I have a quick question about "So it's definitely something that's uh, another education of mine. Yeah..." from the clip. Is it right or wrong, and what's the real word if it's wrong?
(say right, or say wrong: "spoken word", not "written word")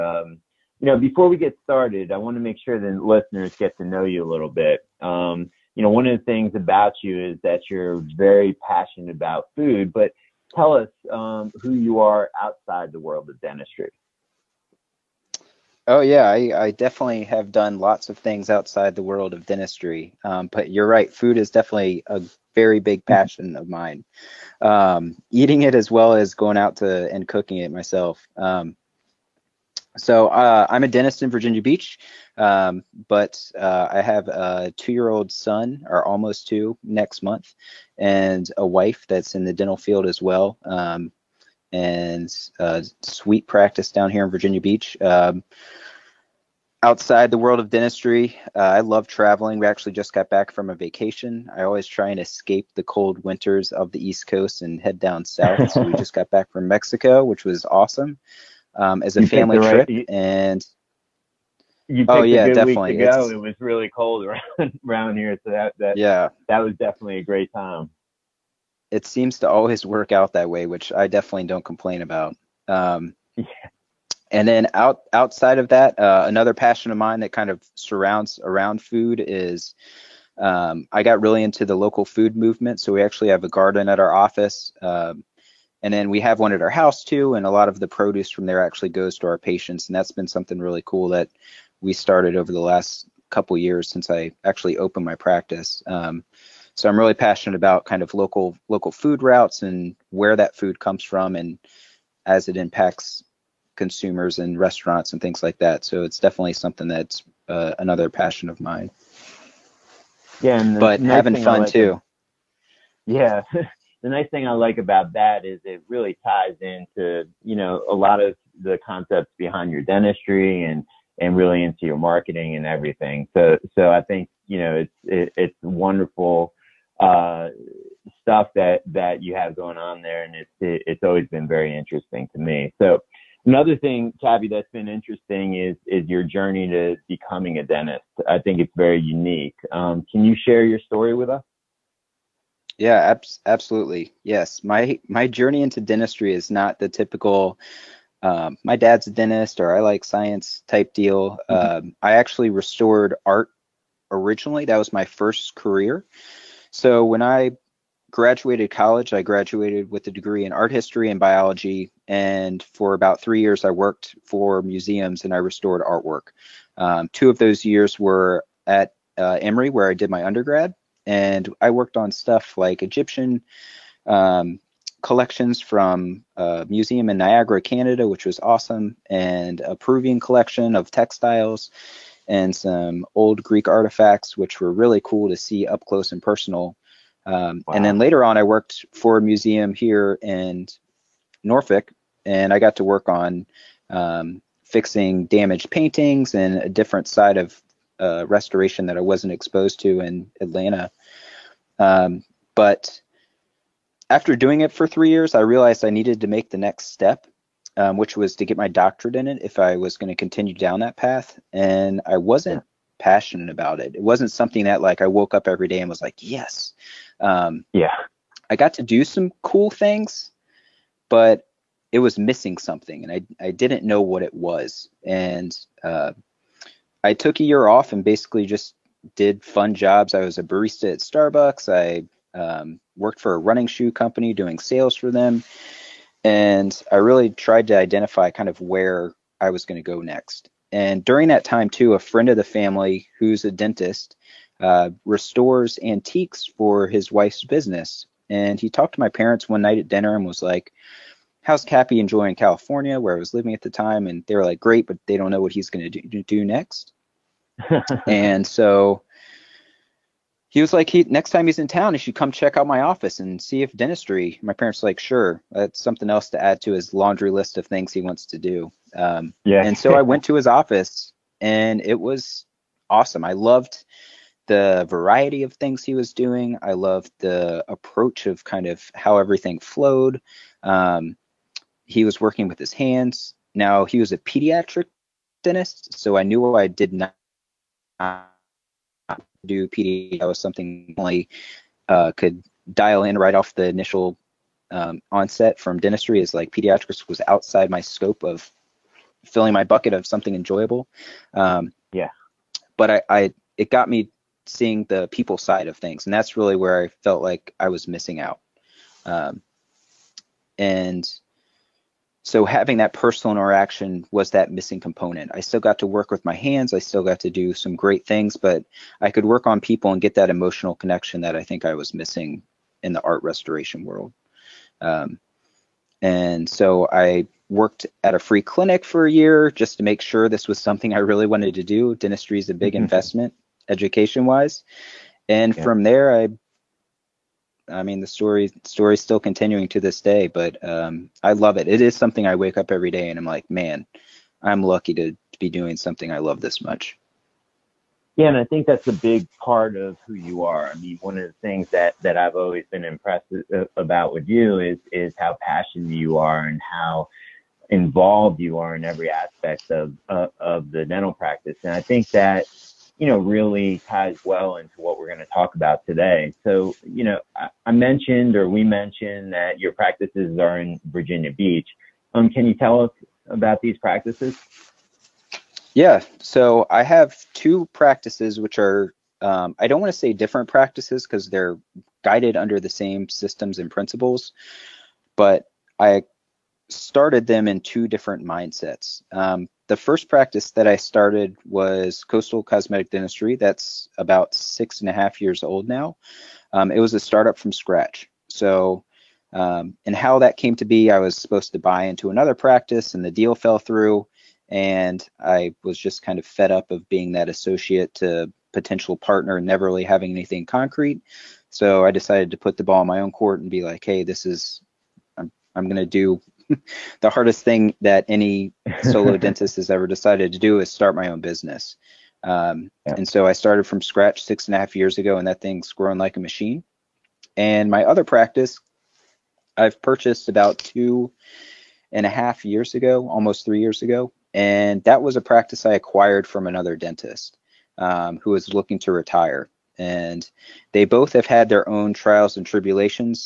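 wrong: "passion", not "education".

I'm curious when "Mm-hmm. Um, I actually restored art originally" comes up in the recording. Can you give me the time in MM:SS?
02:31.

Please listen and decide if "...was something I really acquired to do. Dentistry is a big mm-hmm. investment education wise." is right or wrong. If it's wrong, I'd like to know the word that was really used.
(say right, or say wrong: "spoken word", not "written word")
wrong: "wanted", not "acquired".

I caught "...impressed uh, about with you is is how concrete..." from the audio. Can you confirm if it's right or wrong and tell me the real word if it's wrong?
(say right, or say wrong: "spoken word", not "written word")
wrong: "passionate", not "concrete".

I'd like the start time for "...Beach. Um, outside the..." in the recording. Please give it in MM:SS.
00:44.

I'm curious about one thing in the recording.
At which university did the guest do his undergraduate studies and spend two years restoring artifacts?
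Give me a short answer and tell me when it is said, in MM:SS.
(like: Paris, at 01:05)
Emory, at 02:49.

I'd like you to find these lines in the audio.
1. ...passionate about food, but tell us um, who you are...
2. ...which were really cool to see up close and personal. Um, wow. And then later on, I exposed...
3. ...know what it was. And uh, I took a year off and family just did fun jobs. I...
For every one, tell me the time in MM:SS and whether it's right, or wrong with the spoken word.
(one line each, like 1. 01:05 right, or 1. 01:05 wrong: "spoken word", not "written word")
1. 00:08 right
2. 03:04 wrong: "worked", not "exposed"
3. 03:43 wrong: "basically", not "family".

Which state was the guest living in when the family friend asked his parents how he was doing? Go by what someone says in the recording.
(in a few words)
California.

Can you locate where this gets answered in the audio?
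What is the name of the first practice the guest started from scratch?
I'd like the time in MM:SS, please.
06:32.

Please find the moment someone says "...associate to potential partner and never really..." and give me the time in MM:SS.
06:47.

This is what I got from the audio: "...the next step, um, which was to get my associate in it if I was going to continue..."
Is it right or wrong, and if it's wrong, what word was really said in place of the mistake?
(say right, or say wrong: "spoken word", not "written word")
wrong: "doctorate", not "associate".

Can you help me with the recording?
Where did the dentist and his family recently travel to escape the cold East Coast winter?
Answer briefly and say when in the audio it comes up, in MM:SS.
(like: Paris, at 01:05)
Mexico, at 00:56.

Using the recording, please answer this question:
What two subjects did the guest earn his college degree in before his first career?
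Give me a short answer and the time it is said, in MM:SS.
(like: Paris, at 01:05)
Art history and biology, at 02:40.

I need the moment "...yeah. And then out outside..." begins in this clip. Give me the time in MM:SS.
01:13.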